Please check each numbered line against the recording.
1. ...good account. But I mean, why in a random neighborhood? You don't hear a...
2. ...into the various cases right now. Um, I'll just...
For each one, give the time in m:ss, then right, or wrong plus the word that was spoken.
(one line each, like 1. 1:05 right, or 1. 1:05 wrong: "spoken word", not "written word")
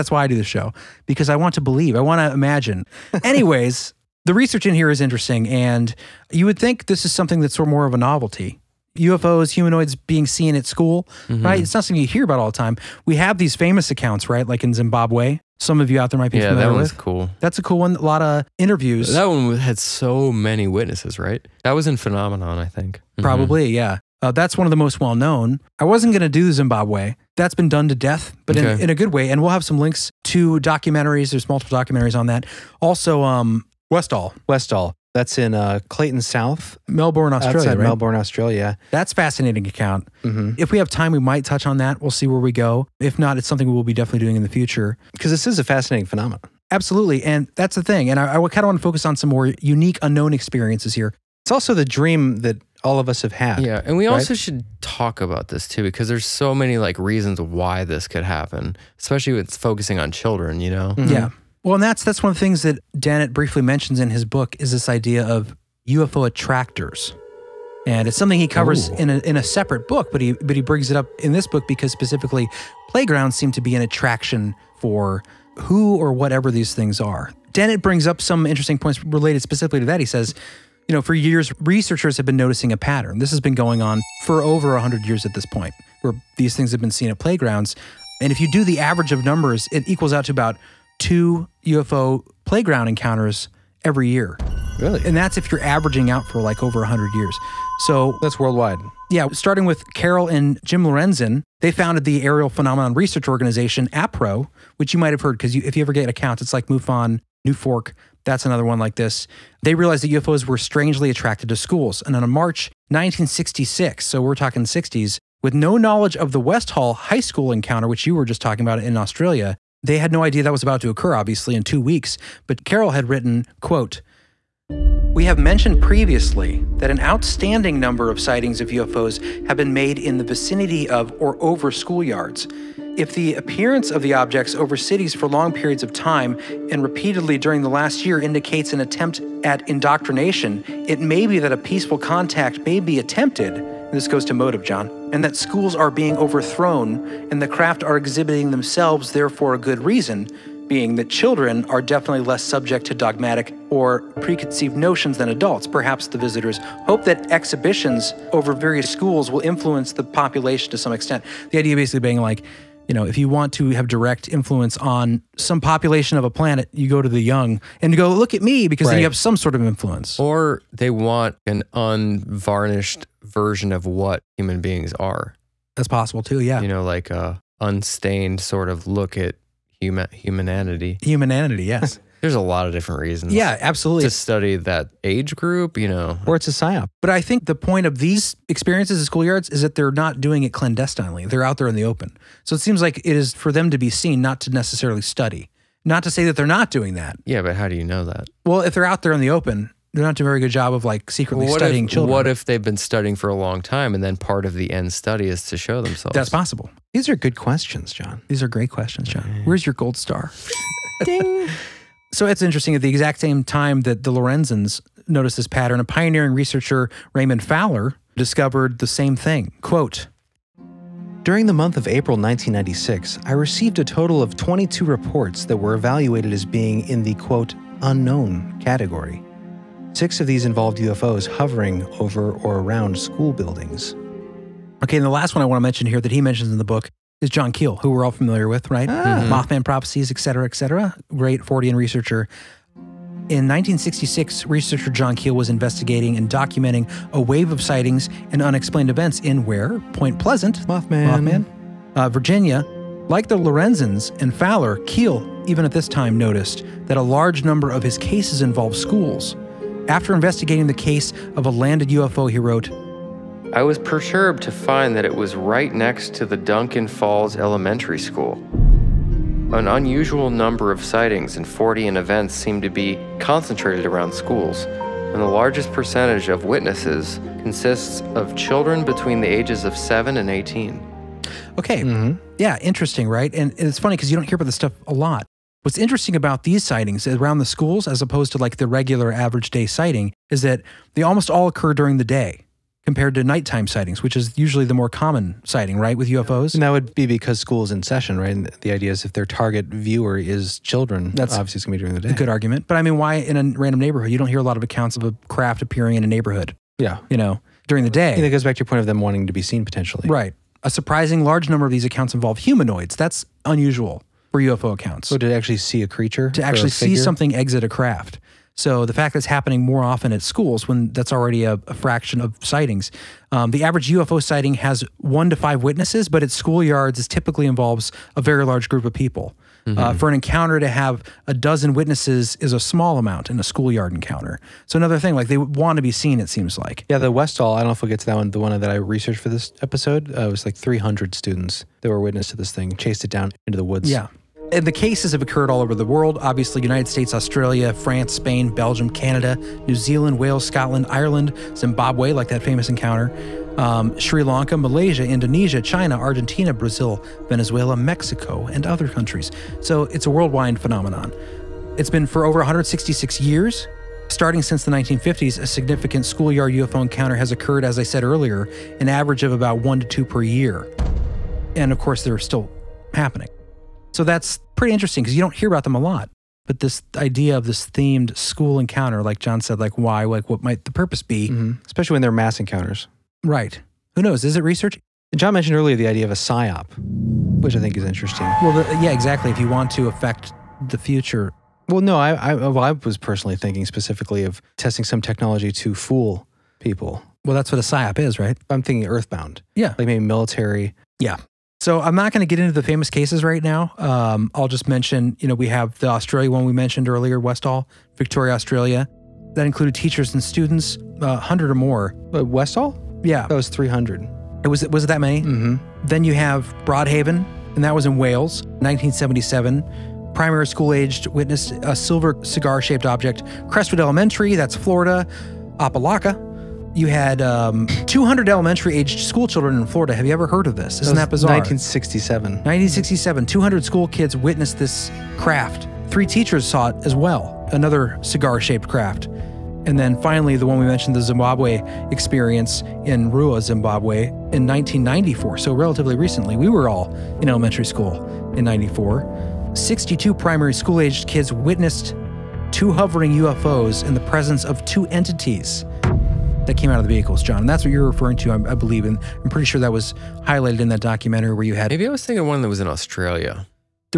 1. 5:02 wrong: "argument", not "account"
2. 6:42 wrong: "famous", not "various".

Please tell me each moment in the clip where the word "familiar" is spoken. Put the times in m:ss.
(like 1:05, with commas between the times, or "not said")
0:16, 3:58.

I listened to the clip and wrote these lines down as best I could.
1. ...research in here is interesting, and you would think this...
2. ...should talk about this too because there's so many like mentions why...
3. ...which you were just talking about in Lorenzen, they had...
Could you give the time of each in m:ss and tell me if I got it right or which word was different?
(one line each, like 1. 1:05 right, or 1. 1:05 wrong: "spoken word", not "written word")
1. 0:04 right
2. 0:54 wrong: "reasons", not "mentions"
3. 1:57 wrong: "Australia", not "Lorenzen".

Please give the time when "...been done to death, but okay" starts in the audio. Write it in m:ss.
0:27.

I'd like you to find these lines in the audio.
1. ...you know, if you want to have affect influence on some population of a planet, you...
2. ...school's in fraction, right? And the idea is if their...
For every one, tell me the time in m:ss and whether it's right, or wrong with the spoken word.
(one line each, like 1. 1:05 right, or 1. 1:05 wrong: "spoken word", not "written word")
1. 2:42 wrong: "direct", not "affect"
2. 4:57 wrong: "session", not "fraction".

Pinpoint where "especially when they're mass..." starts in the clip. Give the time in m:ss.
6:21.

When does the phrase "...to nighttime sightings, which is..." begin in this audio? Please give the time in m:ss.
4:53.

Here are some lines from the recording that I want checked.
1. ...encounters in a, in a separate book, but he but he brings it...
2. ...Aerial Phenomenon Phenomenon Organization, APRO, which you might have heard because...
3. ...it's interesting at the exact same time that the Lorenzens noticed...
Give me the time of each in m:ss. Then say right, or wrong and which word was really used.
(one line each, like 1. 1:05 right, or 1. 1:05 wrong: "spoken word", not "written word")
1. 1:08 wrong: "covers", not "encounters"
2. 1:42 wrong: "Research", not "Phenomenon"
3. 3:32 right.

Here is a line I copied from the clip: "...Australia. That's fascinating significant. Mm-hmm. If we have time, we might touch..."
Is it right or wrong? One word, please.
wrong.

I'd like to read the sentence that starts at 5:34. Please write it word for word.
So another thing, like they want to be seen, it seems like.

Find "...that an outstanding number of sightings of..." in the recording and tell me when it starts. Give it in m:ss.
2:06.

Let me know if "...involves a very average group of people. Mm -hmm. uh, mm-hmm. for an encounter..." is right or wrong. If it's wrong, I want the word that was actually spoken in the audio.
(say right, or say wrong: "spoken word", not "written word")
wrong: "large", not "average".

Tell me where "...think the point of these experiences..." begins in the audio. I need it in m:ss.
3:07.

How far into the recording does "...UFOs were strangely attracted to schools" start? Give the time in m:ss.
1:50.